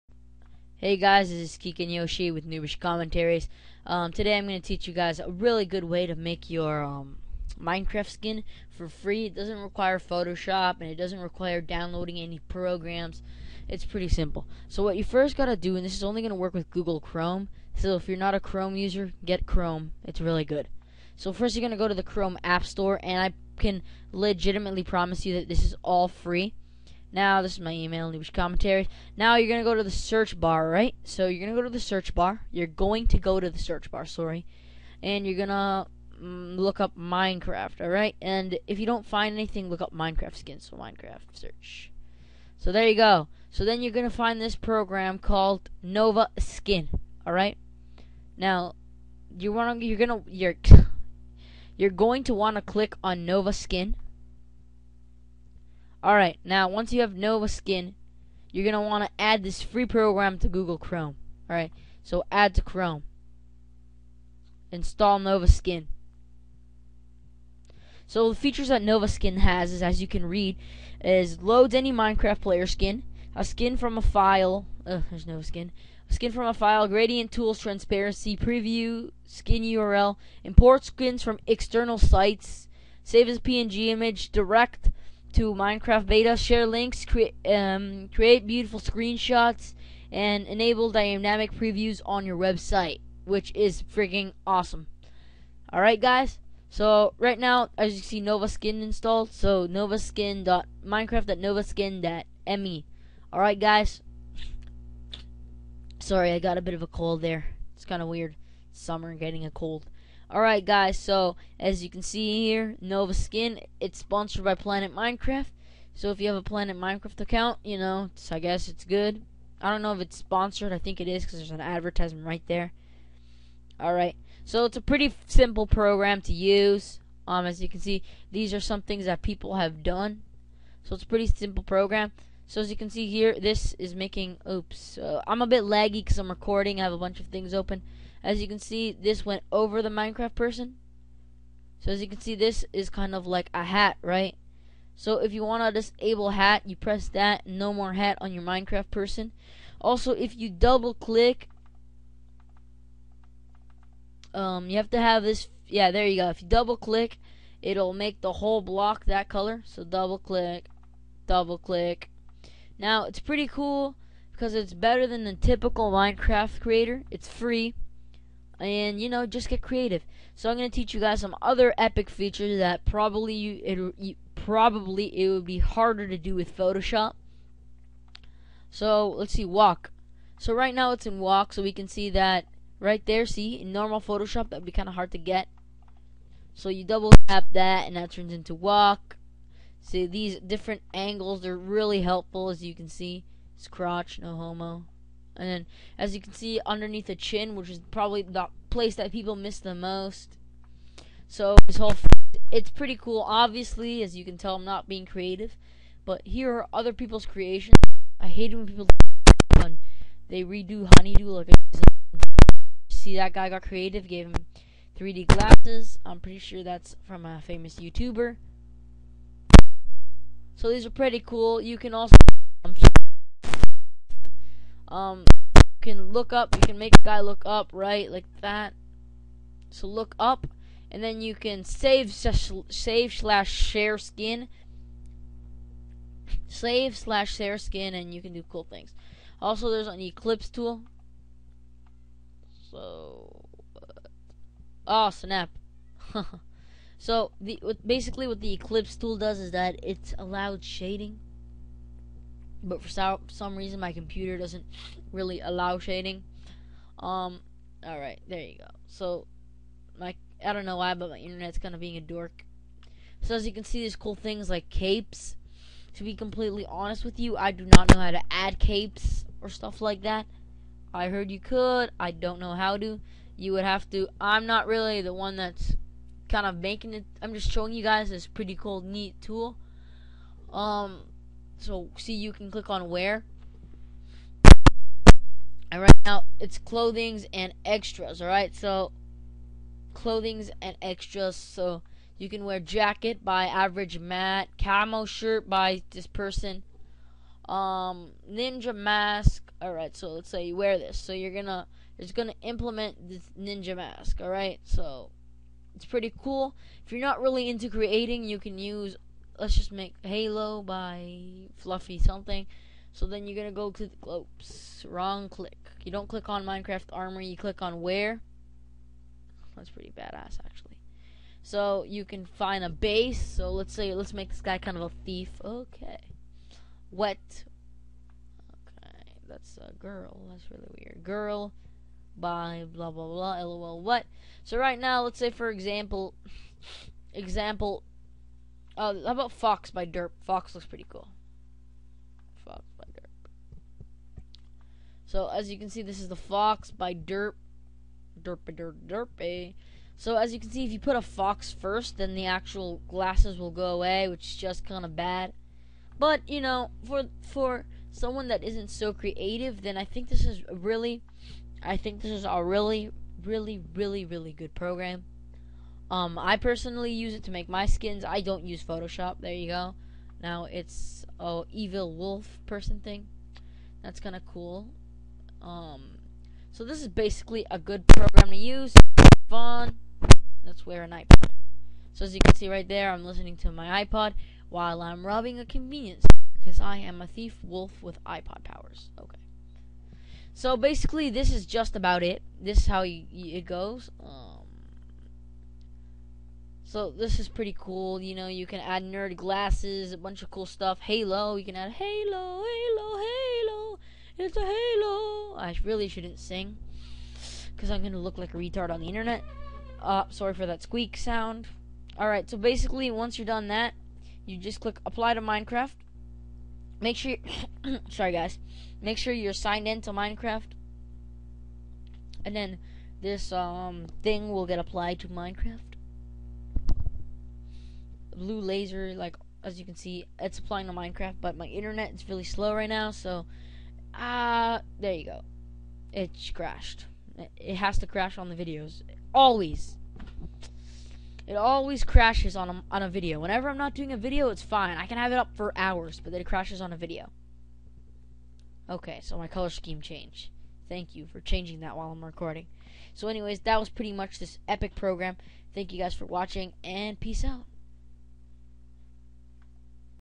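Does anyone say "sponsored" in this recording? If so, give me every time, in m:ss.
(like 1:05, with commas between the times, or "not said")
1:53, 2:00.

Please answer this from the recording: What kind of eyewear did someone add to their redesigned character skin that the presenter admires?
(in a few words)
3D glasses.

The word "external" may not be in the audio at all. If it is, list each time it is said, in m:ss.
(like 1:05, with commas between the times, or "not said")
1:21.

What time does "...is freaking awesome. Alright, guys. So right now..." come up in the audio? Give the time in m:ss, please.
1:33.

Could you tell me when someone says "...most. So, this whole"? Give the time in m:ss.
3:19.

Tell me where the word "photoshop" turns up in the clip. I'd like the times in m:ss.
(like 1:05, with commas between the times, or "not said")
0:09, 2:56, 3:03, 6:08.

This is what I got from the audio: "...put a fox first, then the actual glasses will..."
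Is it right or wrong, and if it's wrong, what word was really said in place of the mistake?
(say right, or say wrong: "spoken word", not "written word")
right.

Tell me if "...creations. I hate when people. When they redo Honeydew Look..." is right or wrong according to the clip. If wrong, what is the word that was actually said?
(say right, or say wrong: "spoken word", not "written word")
right.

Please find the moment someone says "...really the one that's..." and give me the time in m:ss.
4:34.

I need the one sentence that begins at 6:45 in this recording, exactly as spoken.
I really shouldn't sing because I'm gonna look like a retard on the internet.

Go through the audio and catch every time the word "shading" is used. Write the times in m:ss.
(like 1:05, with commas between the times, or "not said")
4:10, 4:15.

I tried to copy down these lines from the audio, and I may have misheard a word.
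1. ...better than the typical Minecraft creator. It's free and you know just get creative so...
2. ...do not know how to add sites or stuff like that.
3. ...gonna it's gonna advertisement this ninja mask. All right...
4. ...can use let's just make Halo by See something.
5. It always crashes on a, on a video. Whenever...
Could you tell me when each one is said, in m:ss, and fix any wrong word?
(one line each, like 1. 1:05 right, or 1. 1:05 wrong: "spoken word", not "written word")
1. 2:44 right
2. 4:27 wrong: "capes", not "sites"
3. 5:01 wrong: "implement", not "advertisement"
4. 5:08 wrong: "Fluffy", not "See"
5. 7:21 right.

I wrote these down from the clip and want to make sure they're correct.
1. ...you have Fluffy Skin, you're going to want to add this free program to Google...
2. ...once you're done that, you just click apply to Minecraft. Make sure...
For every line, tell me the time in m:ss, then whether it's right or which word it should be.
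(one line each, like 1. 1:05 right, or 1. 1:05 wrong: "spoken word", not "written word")
1. 0:56 wrong: "Nova", not "Fluffy"
2. 6:52 right.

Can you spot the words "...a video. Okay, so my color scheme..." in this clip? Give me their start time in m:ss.
7:26.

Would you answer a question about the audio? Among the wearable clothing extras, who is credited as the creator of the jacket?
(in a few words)
Average Matt.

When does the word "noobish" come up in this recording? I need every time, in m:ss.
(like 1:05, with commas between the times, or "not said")
0:02, 0:28.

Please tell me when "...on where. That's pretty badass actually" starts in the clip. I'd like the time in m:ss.
5:17.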